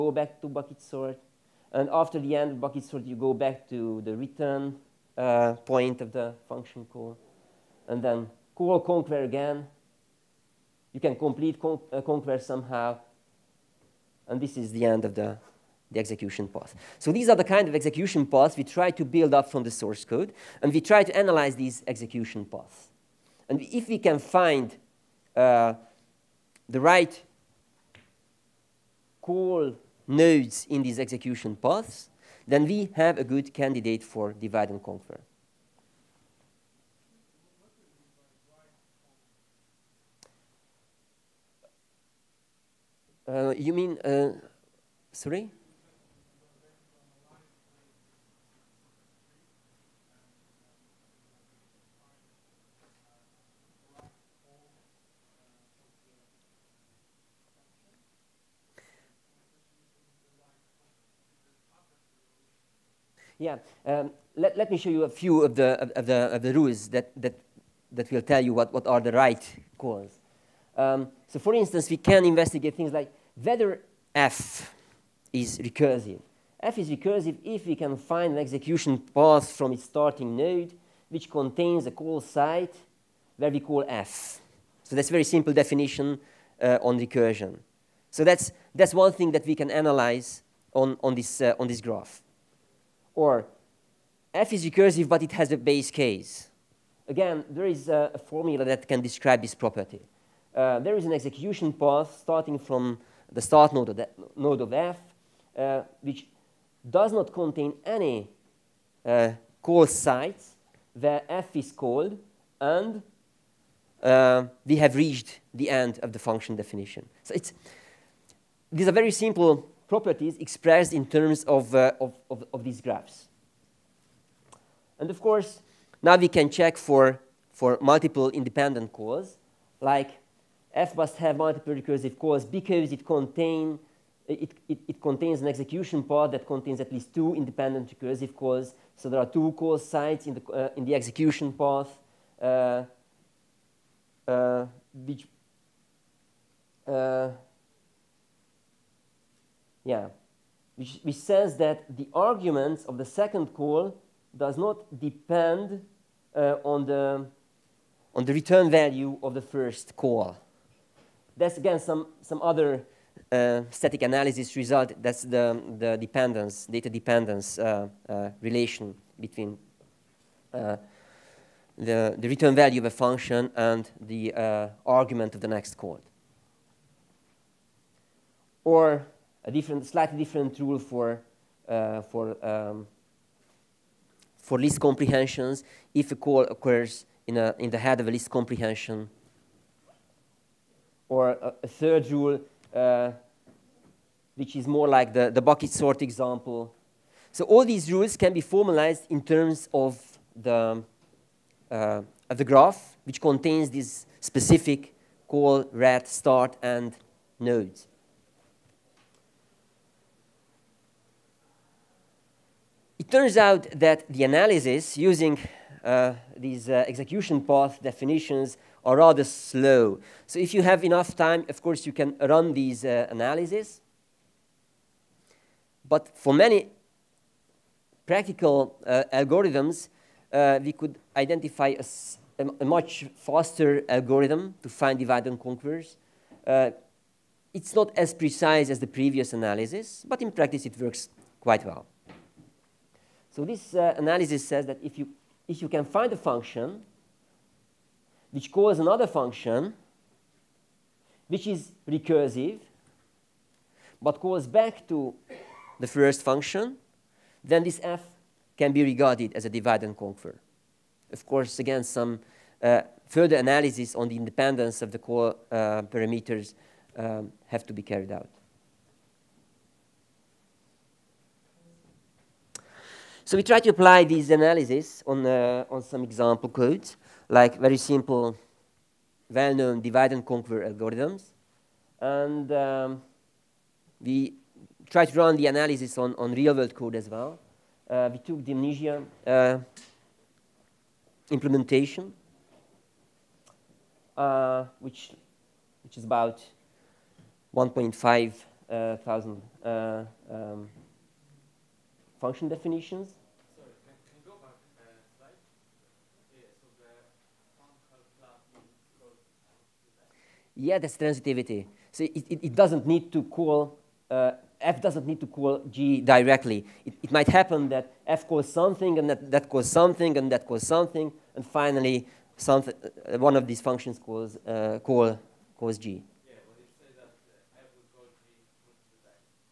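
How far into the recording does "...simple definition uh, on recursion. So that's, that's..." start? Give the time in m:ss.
1:25.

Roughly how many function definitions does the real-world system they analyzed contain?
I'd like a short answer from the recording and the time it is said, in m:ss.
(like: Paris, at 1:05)
1,500, at 4:57.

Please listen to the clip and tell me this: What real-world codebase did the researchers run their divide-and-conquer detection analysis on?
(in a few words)
Mnesia.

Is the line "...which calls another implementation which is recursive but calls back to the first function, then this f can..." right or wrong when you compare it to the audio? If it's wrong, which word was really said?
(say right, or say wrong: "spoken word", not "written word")
wrong: "function", not "implementation".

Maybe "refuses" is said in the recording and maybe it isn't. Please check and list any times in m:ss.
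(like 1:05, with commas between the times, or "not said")
not said.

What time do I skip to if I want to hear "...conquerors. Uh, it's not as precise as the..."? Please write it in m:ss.
3:55.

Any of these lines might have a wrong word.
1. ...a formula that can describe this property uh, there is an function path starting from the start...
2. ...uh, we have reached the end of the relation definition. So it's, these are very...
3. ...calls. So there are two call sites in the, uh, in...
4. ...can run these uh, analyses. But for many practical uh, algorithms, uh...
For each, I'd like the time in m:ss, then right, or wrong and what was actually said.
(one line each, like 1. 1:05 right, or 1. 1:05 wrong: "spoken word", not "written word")
1. 1:38 wrong: "execution", not "function"
2. 1:54 wrong: "function", not "relation"
3. 2:18 right
4. 3:41 right.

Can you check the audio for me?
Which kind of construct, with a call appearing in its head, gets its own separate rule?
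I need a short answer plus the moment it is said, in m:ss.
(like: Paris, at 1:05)
List comprehensions, at 3:04.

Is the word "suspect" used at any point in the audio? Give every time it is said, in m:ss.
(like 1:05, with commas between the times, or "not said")
not said.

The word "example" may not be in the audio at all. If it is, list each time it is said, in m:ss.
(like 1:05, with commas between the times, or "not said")
3:16, 4:36.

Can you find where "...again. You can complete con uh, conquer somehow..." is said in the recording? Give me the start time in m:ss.
0:09.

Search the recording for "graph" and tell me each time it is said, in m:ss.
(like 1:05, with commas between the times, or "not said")
1:31, 2:02, 3:22.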